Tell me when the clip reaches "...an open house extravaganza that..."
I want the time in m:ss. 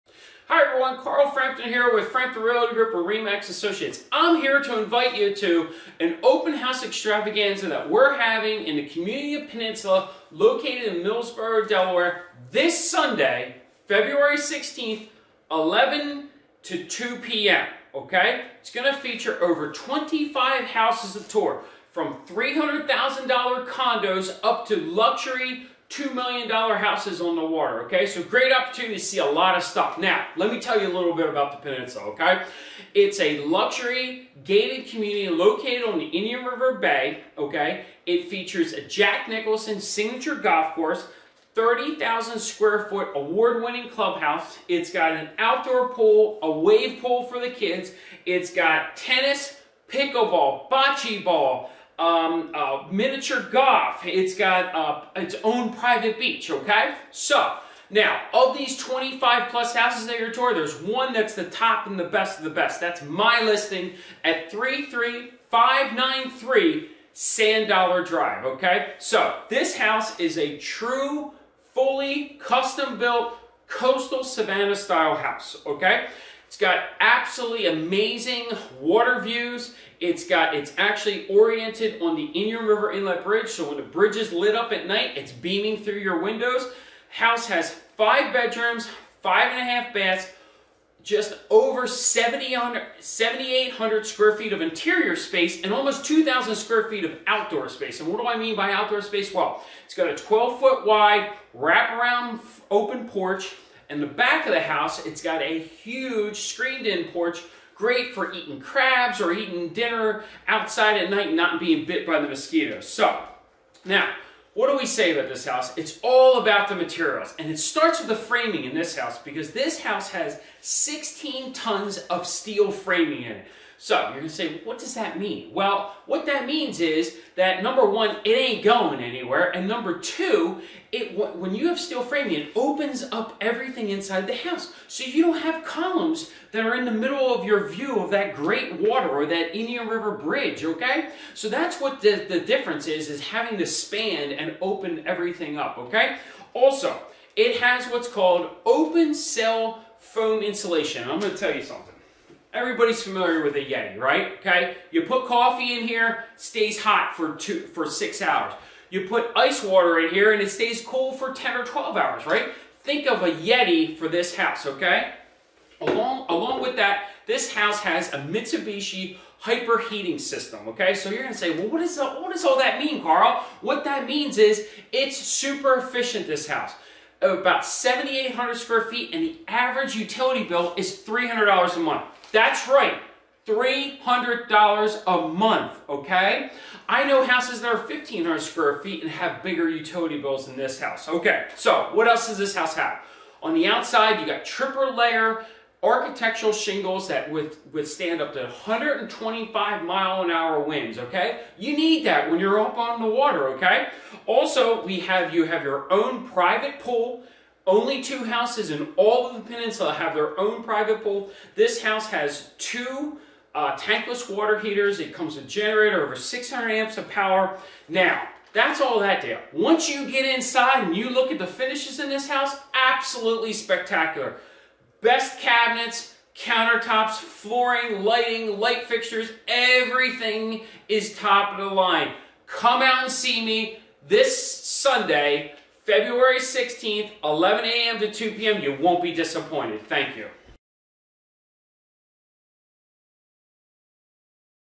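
0:05.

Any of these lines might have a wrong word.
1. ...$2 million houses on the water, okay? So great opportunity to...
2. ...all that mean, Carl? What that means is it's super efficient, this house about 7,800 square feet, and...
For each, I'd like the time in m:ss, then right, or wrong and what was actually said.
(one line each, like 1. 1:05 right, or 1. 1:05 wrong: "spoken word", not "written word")
1. 0:25 right
2. 2:52 right.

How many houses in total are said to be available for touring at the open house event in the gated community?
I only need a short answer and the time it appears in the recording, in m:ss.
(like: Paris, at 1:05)
Over 25, at 0:19.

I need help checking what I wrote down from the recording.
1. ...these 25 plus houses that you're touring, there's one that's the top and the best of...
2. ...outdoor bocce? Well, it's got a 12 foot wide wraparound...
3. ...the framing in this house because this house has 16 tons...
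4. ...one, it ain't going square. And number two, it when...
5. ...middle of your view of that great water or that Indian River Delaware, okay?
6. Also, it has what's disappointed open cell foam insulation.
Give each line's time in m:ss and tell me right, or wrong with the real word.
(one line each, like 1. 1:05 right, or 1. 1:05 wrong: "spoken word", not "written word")
1. 0:58 right
2. 1:38 wrong: "space", not "bocce"
3. 1:58 right
4. 2:07 wrong: "anywhere", not "square"
5. 2:16 wrong: "Bridge", not "Delaware"
6. 2:26 wrong: "called", not "disappointed".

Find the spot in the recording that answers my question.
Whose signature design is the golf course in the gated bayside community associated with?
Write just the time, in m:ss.
0:38.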